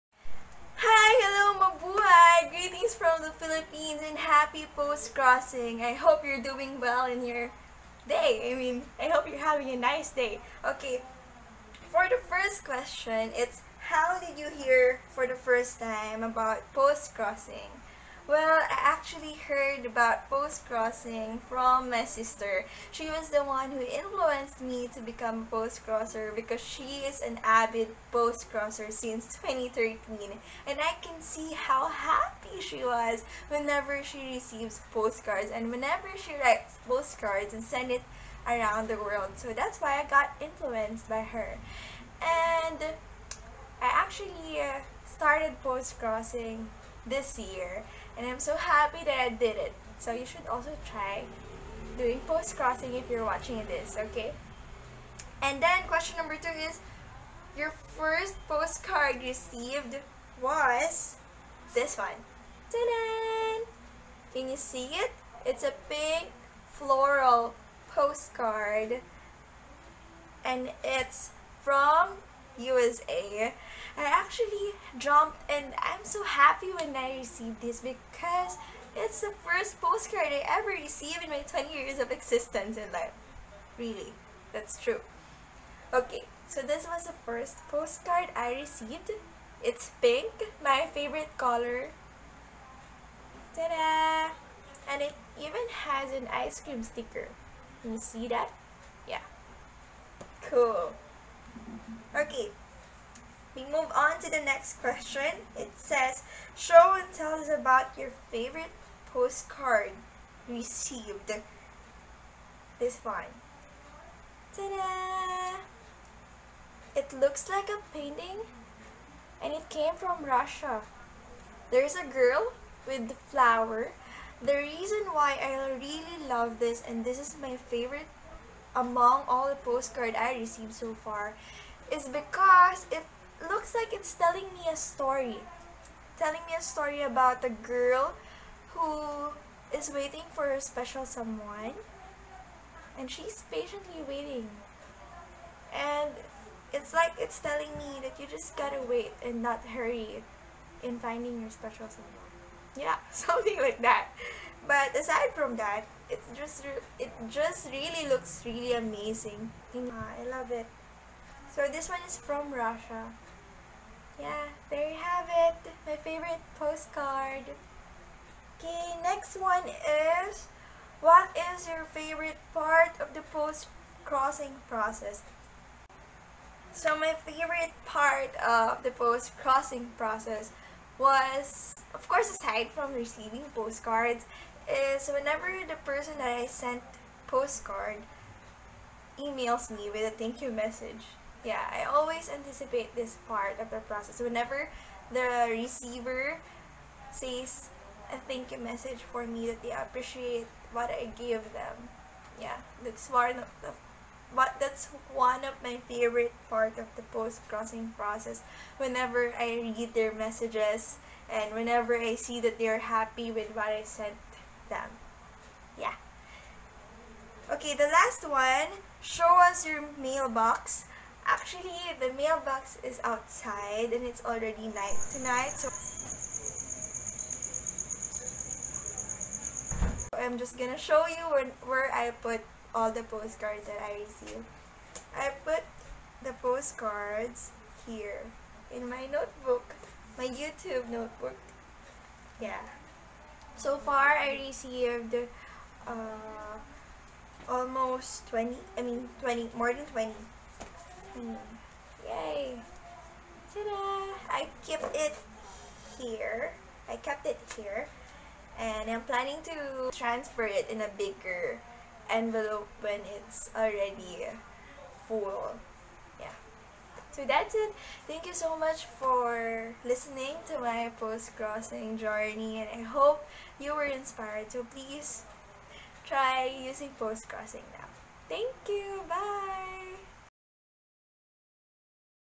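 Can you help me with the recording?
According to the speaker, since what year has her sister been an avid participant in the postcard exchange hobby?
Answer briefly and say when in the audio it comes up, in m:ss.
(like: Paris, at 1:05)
2013, at 0:29.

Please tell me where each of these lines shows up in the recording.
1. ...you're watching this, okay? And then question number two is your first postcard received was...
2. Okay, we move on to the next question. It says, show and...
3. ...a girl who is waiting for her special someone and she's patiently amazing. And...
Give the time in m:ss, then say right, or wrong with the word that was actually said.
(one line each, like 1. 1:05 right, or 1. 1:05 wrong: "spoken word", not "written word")
1. 0:53 right
2. 1:42 right
3. 2:17 wrong: "waiting", not "amazing".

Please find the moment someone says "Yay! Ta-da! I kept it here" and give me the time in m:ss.
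4:12.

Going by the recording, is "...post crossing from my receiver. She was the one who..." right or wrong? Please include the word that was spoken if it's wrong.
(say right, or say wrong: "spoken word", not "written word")
wrong: "sister", not "receiver".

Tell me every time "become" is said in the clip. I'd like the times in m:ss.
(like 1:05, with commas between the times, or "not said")
0:25.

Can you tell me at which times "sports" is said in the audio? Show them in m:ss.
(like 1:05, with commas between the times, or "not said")
not said.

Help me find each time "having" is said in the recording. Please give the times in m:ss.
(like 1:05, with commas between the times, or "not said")
0:09.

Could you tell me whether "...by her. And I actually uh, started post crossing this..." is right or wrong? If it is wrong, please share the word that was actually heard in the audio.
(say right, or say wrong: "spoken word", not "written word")
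right.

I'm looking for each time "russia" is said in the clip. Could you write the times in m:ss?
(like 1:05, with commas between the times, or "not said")
2:00, 2:42.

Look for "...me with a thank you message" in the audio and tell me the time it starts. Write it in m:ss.
3:09.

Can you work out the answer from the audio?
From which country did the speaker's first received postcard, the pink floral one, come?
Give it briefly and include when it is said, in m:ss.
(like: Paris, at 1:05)
USA, at 1:12.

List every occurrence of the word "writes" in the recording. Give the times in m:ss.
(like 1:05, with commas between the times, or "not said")
0:36.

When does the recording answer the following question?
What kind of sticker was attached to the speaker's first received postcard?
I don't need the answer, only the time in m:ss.
1:36.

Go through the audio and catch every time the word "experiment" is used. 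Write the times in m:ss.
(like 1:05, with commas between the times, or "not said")
not said.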